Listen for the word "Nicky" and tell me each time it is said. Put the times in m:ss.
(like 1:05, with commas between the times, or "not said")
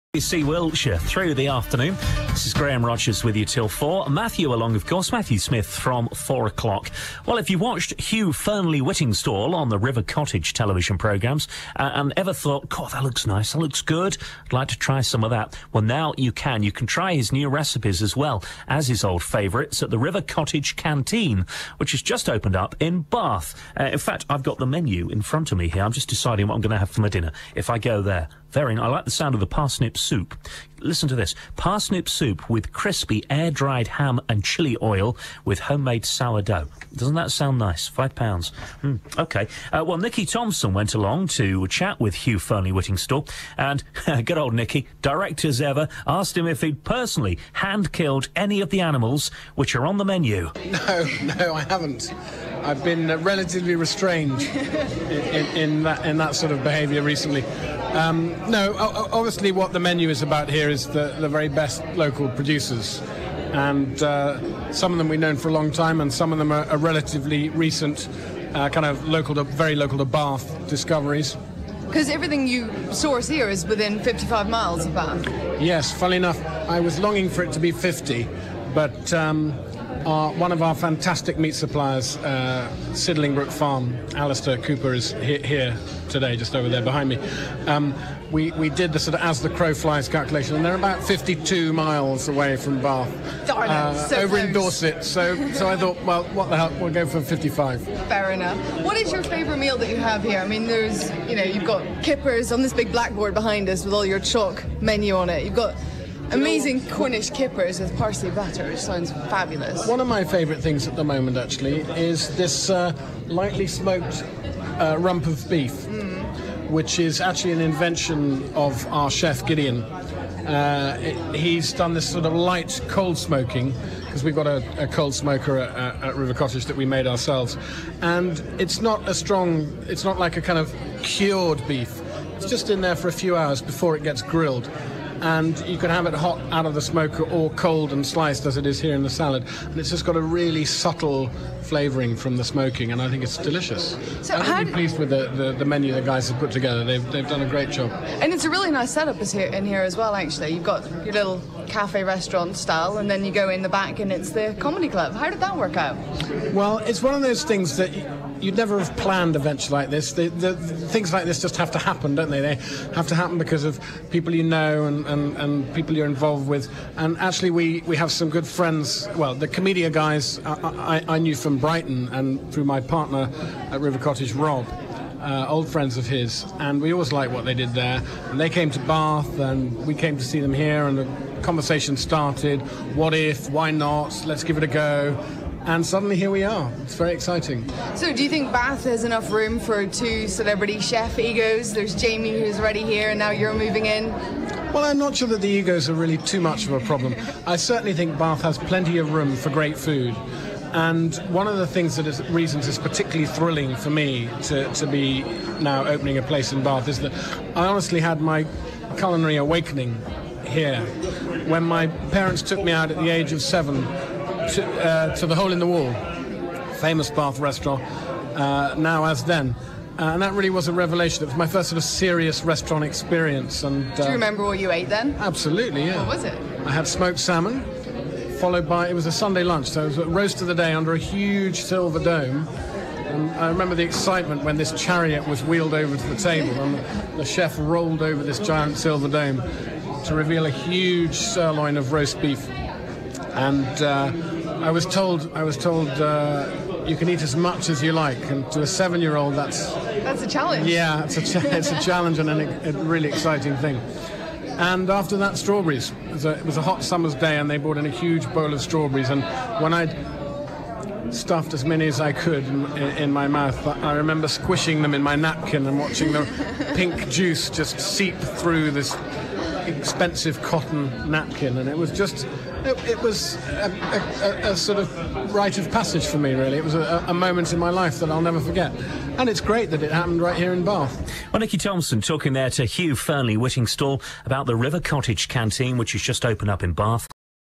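4:41.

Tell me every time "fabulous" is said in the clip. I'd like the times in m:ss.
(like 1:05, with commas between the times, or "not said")
1:49.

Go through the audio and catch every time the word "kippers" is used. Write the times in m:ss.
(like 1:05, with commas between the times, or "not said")
1:42, 1:47.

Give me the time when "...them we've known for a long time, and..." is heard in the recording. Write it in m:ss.
1:04.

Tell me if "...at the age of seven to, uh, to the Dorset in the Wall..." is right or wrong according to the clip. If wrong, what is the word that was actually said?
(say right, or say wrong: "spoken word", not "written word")
wrong: "Hole", not "Dorset".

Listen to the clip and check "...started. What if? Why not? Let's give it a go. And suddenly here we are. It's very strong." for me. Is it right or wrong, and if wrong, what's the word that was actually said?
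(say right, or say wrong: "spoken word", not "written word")
wrong: "exciting", not "strong".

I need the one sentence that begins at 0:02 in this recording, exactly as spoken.
This is Graham Rogers with you till four.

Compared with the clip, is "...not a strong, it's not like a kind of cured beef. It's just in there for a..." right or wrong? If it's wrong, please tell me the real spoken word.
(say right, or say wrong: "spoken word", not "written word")
right.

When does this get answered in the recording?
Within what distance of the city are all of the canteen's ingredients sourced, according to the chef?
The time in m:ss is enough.
1:13.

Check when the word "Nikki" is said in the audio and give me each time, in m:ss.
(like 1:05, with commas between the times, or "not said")
0:39, 0:44.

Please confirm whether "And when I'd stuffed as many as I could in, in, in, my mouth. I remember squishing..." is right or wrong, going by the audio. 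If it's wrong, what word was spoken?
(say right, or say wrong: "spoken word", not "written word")
right.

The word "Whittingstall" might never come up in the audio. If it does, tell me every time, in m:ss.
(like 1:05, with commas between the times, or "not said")
0:08, 0:42, 4:43.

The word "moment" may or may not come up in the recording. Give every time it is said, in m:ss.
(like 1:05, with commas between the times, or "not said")
1:51, 4:37.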